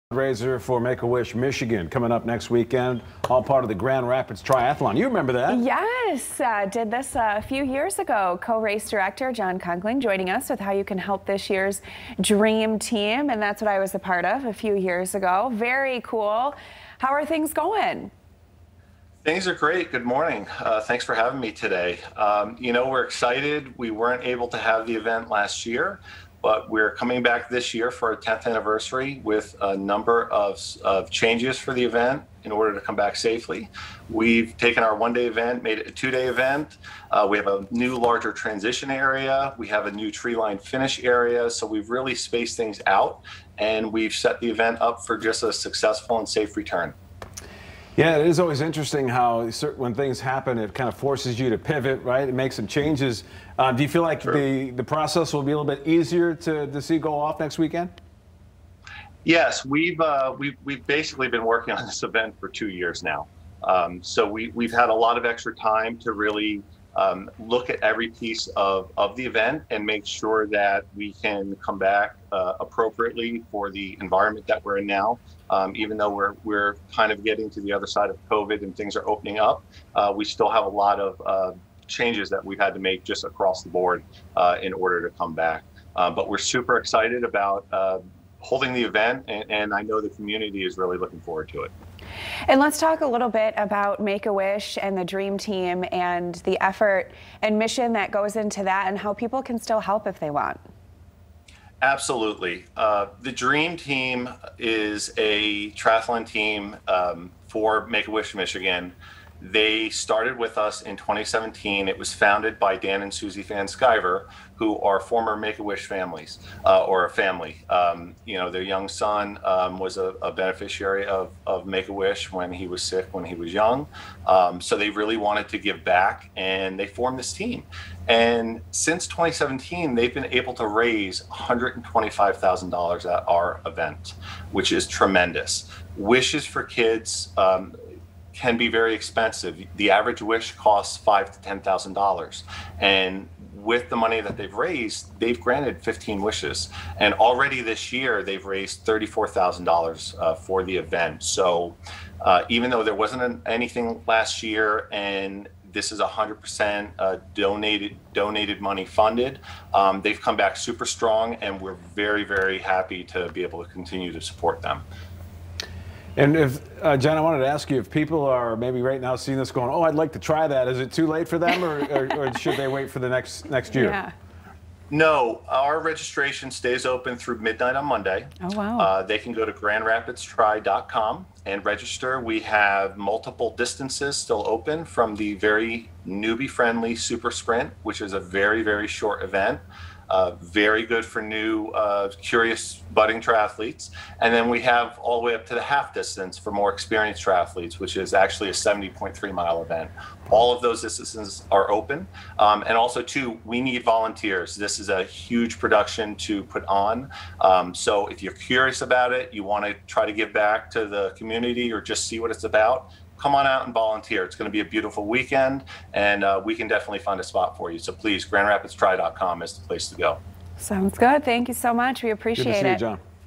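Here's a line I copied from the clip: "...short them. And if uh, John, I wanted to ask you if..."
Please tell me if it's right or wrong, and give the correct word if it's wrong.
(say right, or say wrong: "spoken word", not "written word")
wrong: "support", not "short".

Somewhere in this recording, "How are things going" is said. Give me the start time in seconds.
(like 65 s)
16 s.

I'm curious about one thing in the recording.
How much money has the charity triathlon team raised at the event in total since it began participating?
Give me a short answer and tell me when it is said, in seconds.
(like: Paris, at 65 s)
$125,000, at 131 s.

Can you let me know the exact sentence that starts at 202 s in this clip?
Um, and also, too, we need volunteers.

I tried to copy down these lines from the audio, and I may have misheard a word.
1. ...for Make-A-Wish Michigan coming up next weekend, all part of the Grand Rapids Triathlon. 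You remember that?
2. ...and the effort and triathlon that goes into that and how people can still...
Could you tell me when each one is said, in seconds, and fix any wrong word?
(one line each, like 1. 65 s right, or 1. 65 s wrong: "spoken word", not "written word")
1. 0 s right
2. 95 s wrong: "mission", not "triathlon".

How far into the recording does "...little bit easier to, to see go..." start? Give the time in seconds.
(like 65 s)
55 s.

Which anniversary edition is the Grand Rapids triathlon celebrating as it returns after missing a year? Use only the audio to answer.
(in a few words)
10th.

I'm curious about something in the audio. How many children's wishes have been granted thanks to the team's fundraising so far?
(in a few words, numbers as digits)
15.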